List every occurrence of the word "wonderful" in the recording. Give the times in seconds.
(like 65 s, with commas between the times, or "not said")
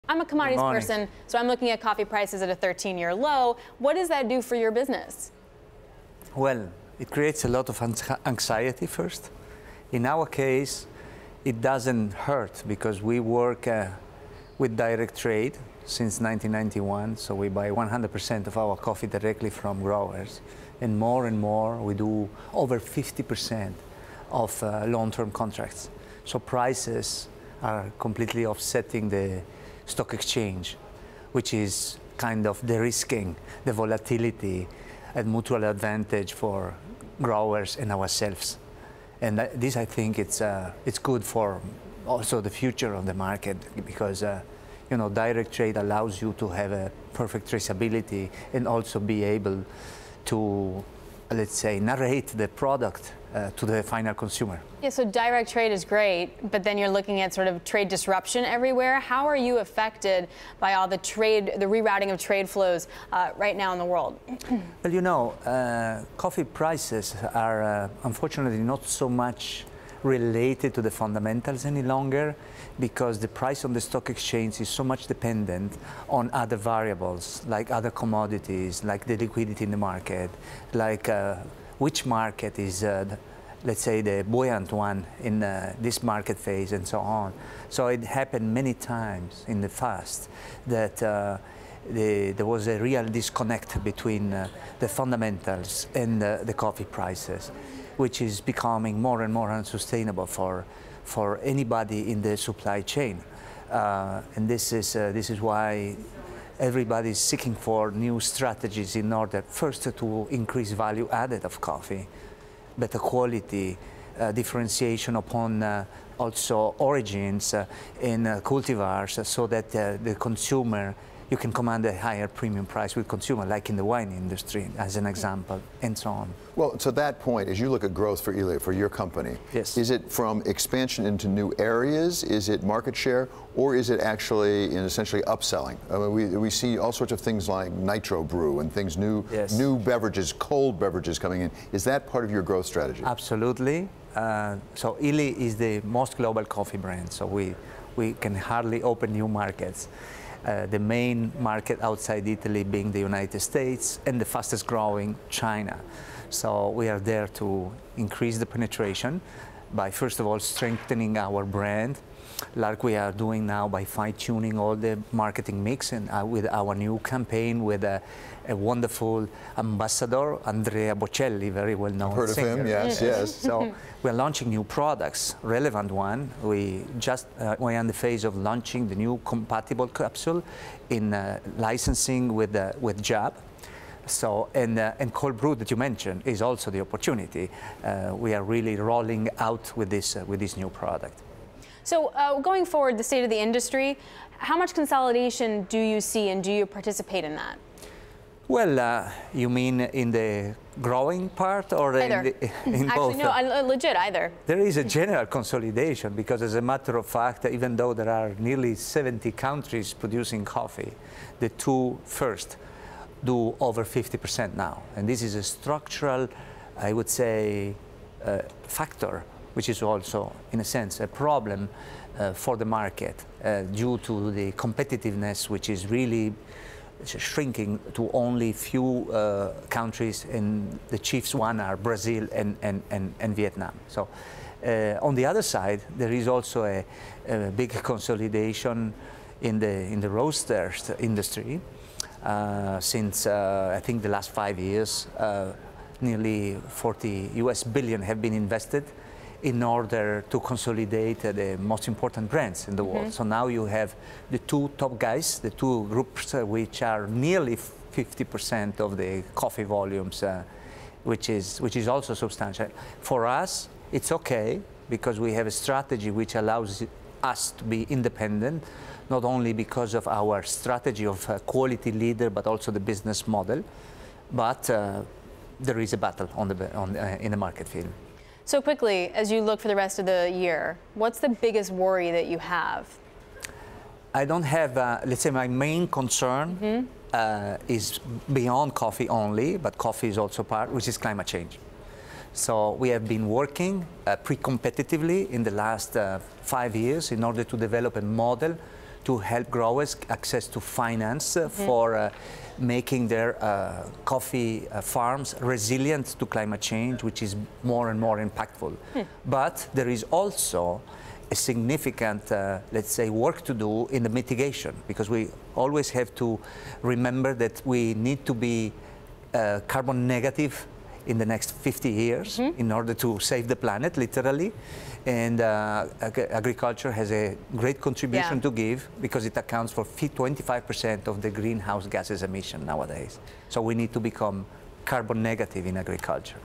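168 s.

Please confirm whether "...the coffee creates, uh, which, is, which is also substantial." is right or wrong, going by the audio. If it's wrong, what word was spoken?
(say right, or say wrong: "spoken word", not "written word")
wrong: "volumes", not "creates".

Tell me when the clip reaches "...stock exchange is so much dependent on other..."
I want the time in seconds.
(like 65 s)
73 s.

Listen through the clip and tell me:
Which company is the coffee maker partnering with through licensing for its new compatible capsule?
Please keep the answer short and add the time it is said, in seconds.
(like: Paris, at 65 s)
JAB, at 183 s.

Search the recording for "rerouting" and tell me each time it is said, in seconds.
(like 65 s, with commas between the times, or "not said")
61 s.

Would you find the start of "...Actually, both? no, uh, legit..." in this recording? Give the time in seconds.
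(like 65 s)
202 s.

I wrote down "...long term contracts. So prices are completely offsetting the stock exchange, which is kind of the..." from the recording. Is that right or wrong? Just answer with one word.
right.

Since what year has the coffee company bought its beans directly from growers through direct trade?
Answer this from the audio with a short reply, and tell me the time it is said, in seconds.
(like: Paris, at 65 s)
1991, at 16 s.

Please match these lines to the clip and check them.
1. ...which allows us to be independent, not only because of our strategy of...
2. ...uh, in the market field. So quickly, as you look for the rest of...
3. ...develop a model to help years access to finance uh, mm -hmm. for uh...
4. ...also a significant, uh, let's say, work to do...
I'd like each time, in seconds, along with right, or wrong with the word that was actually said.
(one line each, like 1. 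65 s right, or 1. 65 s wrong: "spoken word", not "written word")
1. 266 s right
2. 276 s right
3. 297 s wrong: "growers", not "years"
4. 310 s right.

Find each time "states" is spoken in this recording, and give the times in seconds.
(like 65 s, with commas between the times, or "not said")
153 s, 193 s.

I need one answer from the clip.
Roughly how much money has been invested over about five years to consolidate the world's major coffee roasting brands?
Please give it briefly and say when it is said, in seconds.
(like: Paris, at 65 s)
40 billion US dollars, at 246 s.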